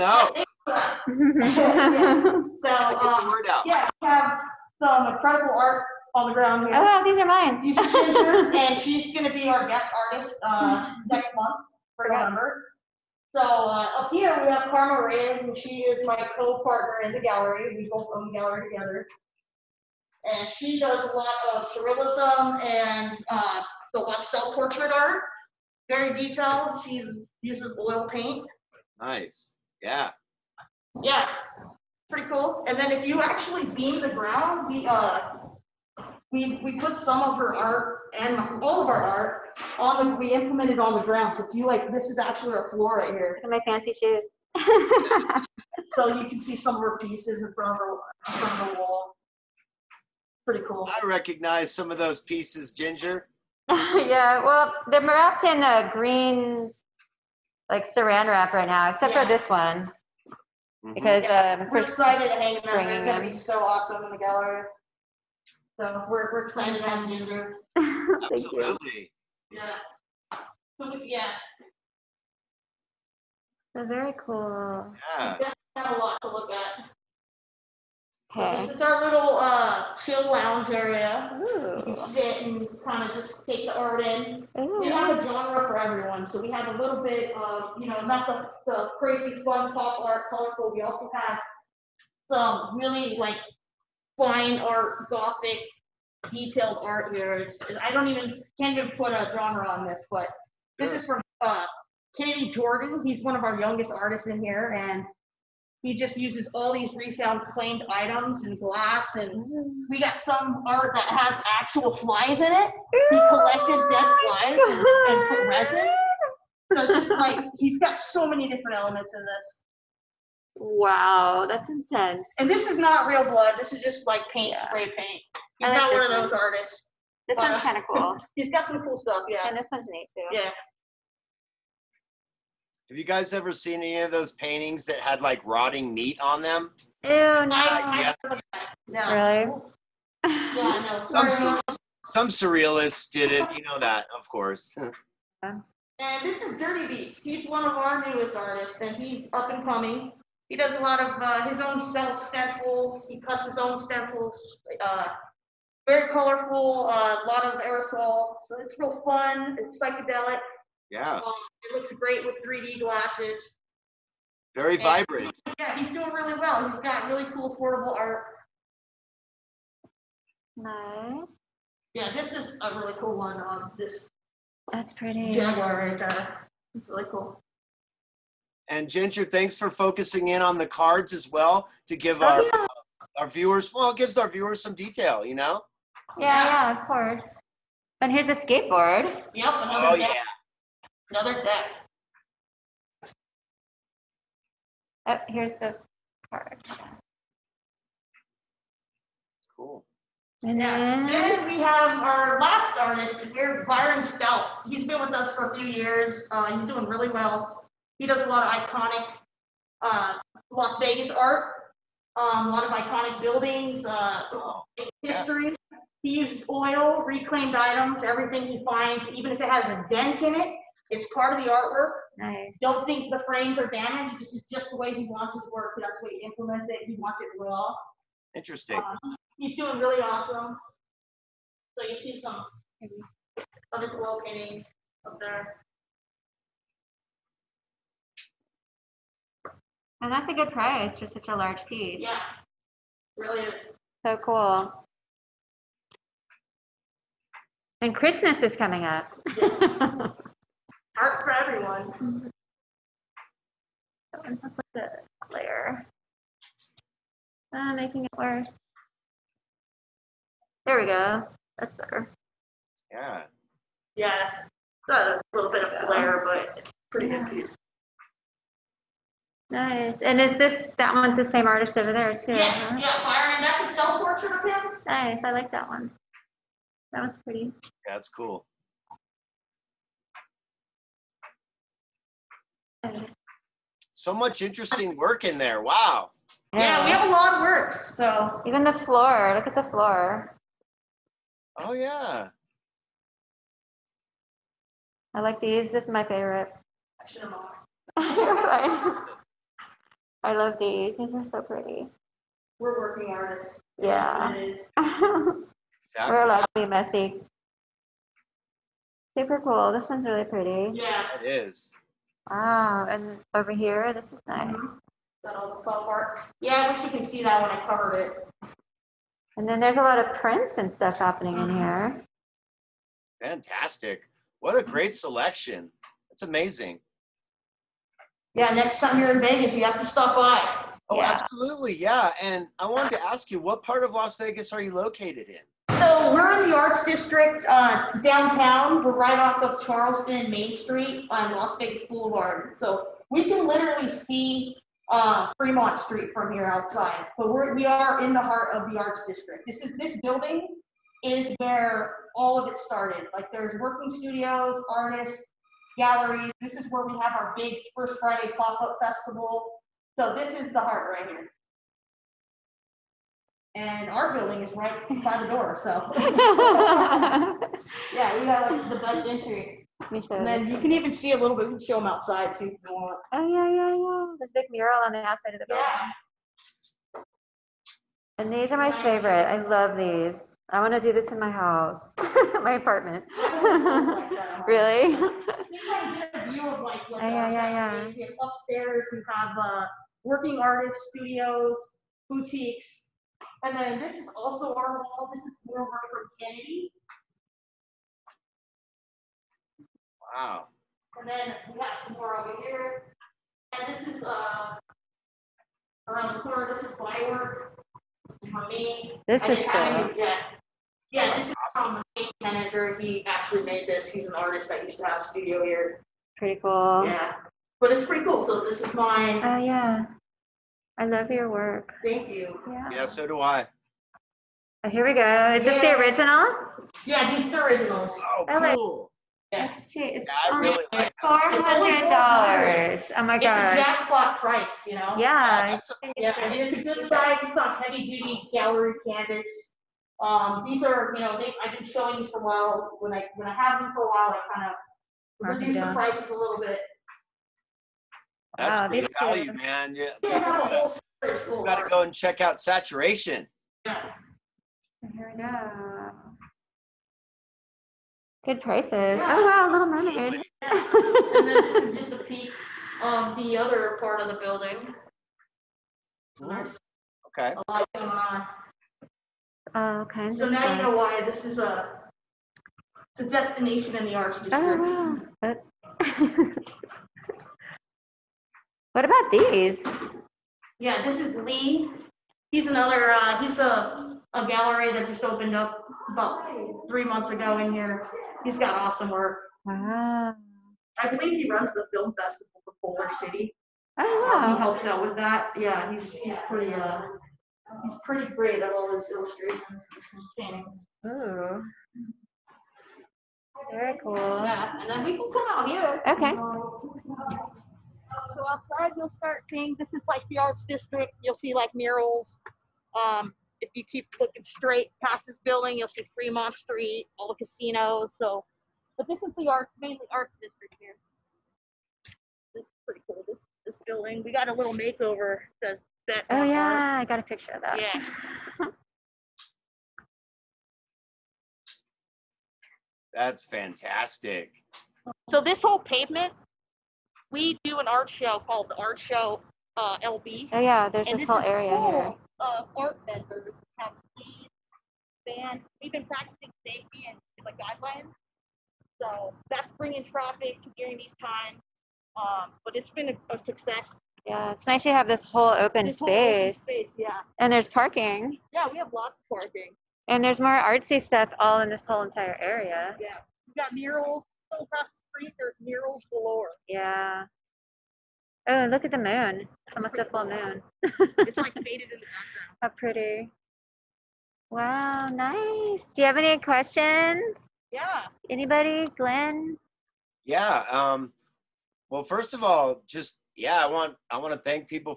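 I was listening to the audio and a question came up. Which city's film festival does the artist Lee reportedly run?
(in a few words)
Boulder City.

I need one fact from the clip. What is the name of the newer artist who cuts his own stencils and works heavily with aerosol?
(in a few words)
Dirty Beats.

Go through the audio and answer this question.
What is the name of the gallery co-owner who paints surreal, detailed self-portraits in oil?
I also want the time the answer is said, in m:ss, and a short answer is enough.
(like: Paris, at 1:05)
Karma Reyes, at 0:14.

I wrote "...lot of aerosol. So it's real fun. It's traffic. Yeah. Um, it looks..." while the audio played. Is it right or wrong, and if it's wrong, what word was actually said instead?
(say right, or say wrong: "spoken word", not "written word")
wrong: "psychedelic", not "traffic".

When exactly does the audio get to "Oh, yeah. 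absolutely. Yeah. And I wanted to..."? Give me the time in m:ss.
5:30.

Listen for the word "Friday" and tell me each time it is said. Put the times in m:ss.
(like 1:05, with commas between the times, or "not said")
5:57.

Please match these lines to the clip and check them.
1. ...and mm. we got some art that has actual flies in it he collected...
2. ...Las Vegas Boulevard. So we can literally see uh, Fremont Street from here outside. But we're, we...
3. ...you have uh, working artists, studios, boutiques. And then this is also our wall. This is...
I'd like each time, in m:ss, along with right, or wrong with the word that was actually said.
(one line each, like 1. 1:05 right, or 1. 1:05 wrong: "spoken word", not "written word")
1. 1:49 right
2. 5:41 right
3. 6:28 right.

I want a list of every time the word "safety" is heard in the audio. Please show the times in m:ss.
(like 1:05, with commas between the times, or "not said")
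9:06.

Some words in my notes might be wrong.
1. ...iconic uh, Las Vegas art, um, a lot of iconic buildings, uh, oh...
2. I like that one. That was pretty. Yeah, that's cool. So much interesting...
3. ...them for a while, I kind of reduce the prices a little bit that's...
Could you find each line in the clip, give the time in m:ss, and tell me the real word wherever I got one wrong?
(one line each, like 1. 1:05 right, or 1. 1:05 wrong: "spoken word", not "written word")
1. 3:28 right
2. 4:35 right
3. 7:23 right.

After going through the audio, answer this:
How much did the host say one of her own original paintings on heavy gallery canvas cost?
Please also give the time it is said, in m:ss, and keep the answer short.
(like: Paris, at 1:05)
$400, at 7:11.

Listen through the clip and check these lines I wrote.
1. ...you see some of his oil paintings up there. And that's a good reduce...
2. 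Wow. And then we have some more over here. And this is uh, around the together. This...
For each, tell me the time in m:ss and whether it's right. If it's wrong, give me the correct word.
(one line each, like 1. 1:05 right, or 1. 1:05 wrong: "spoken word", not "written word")
1. 3:51 wrong: "price", not "reduce"
2. 6:40 wrong: "corner", not "together".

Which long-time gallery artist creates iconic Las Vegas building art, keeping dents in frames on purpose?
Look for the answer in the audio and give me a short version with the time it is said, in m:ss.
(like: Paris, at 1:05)
Byron Stout, at 3:23.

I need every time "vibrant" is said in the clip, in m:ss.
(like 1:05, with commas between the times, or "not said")
2:44.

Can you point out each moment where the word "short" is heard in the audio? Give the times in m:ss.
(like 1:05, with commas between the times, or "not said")
not said.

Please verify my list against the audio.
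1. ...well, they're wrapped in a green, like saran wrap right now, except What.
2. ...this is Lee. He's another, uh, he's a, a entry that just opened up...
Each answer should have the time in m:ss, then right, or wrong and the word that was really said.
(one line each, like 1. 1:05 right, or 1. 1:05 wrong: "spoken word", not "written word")
1. 0:54 wrong: "Yeah", not "What"
2. 8:00 wrong: "gallery", not "entry".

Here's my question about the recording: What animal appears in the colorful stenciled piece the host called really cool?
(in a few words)
Jaguar.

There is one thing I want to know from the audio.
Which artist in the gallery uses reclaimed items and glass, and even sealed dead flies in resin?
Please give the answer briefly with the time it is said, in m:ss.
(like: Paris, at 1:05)
Kennedy Jordan, at 1:42.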